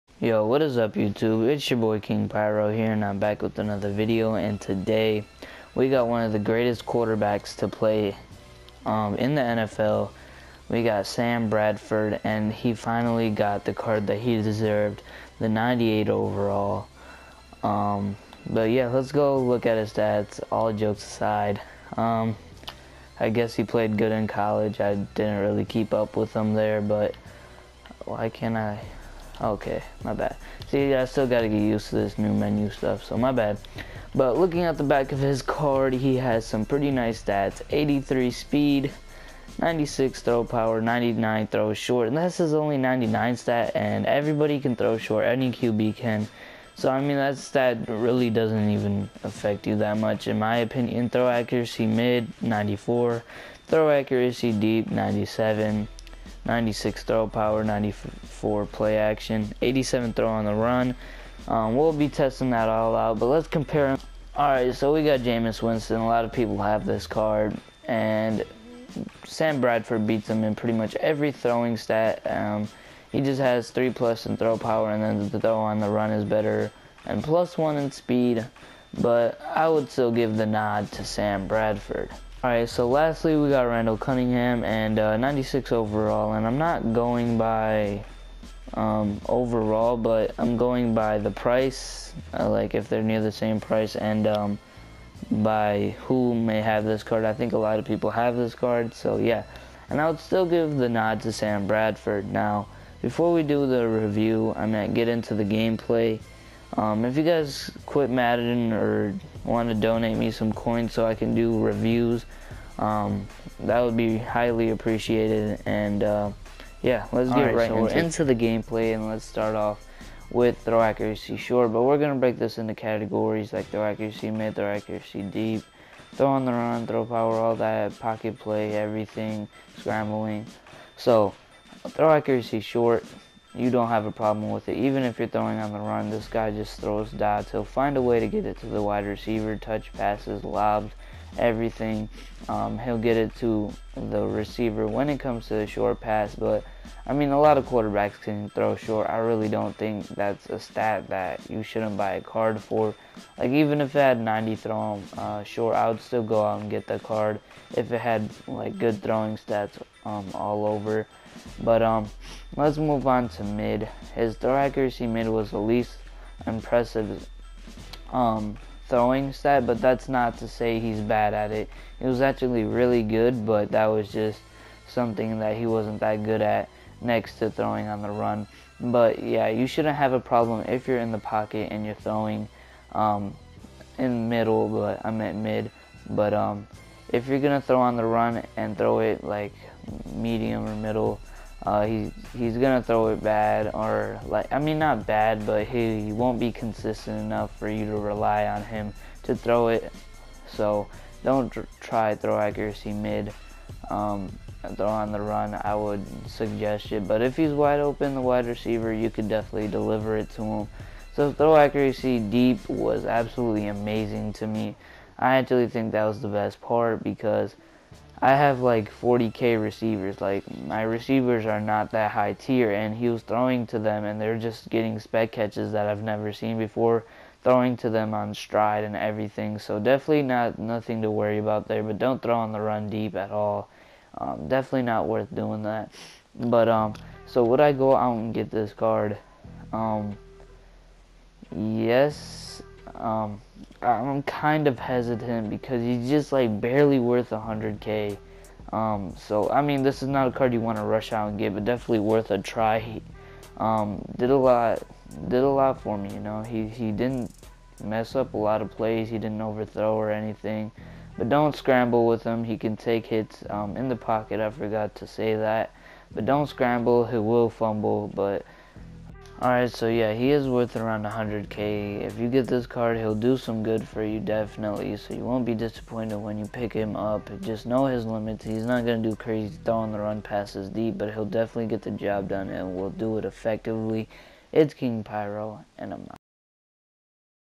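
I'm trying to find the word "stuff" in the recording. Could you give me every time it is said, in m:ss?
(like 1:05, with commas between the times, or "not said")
0:32.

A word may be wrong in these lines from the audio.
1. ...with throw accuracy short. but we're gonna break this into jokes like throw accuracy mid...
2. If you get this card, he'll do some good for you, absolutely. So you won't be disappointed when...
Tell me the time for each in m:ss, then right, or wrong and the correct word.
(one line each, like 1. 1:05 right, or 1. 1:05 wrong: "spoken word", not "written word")
1. 2:00 wrong: "categories", not "jokes"
2. 4:32 wrong: "definitely", not "absolutely".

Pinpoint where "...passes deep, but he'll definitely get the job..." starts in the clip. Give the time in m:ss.
4:40.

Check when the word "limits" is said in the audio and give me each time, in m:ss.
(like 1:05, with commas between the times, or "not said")
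4:38.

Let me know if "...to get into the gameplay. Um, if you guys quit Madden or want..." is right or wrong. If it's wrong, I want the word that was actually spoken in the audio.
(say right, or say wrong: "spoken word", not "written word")
right.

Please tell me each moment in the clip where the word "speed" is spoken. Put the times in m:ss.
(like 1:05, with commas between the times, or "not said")
0:38, 1:17.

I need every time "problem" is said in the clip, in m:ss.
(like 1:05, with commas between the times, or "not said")
2:14, 3:00.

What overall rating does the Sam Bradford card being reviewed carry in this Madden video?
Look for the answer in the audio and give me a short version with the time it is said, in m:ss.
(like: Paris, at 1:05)
98, at 0:15.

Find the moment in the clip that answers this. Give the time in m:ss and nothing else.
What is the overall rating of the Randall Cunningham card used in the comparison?
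1:25.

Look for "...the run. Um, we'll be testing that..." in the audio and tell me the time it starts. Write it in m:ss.
1:00.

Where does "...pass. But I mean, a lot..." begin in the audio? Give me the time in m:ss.
2:25.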